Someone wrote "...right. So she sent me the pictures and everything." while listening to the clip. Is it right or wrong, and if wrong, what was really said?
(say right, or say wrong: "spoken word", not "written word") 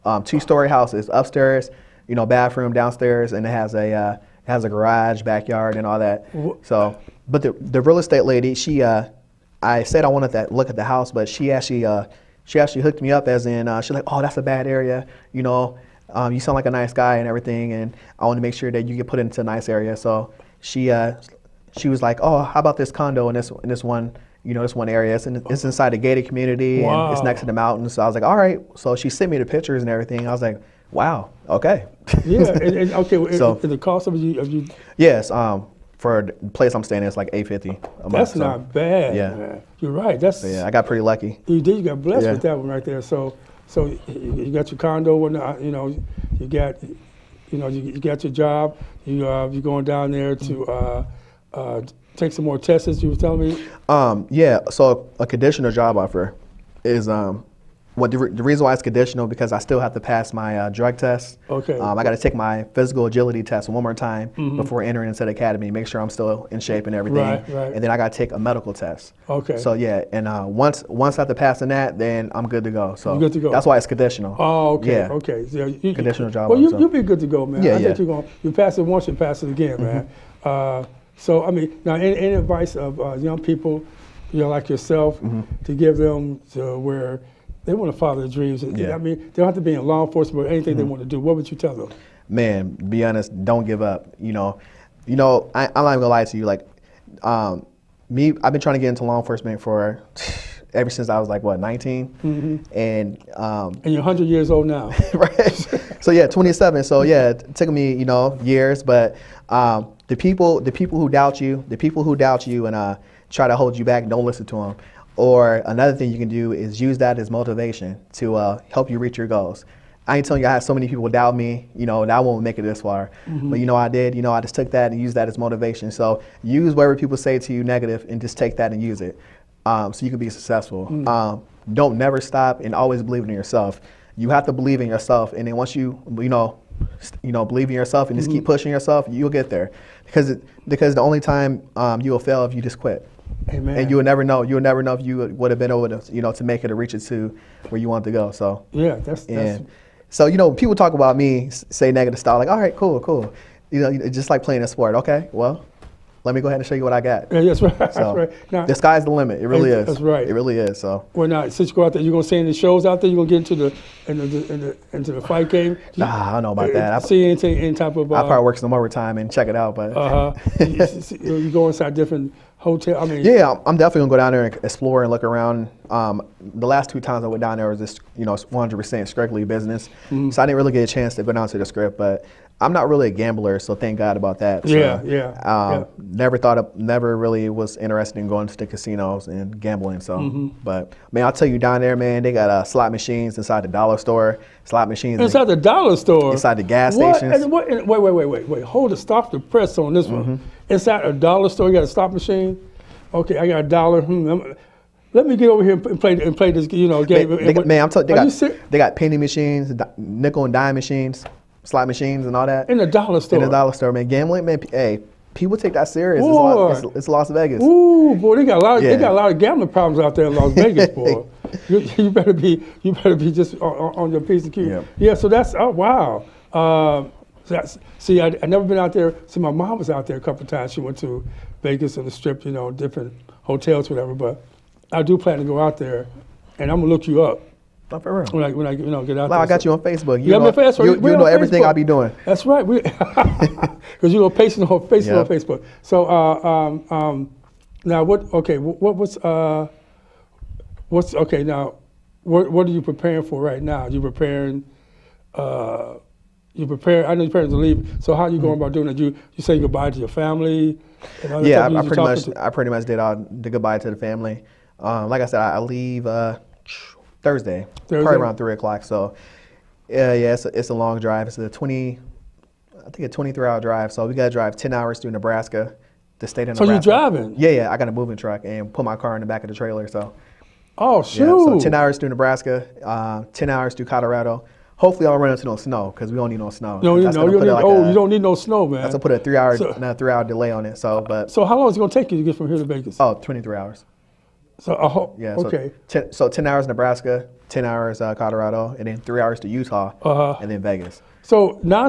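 right.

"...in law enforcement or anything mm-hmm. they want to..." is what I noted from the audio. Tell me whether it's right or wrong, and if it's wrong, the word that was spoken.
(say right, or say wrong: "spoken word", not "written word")
right.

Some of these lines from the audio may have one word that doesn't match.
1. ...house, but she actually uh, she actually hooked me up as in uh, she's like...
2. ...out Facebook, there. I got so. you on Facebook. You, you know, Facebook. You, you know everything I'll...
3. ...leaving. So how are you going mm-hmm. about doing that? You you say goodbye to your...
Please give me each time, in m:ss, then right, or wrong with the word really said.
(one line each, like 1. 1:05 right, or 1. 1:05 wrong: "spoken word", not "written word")
1. 0:10 right
2. 3:59 wrong: "Well", not "Facebook"
3. 4:17 right.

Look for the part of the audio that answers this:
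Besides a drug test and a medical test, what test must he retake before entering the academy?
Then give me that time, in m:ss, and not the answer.
1:02.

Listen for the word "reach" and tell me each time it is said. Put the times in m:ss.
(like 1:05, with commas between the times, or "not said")
1:58, 2:26.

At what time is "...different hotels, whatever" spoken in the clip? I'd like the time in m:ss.
3:52.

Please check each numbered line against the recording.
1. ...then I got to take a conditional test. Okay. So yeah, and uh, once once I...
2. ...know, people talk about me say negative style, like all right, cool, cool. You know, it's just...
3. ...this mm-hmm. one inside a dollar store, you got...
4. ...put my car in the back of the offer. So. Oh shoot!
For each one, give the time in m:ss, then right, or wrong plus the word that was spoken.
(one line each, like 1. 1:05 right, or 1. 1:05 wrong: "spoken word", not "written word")
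1. 1:07 wrong: "medical", not "conditional"
2. 2:30 right
3. 3:19 right
4. 4:38 wrong: "trailer", not "offer".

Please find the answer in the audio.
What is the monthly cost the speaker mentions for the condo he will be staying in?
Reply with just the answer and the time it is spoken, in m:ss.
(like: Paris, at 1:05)
$850, at 0:37.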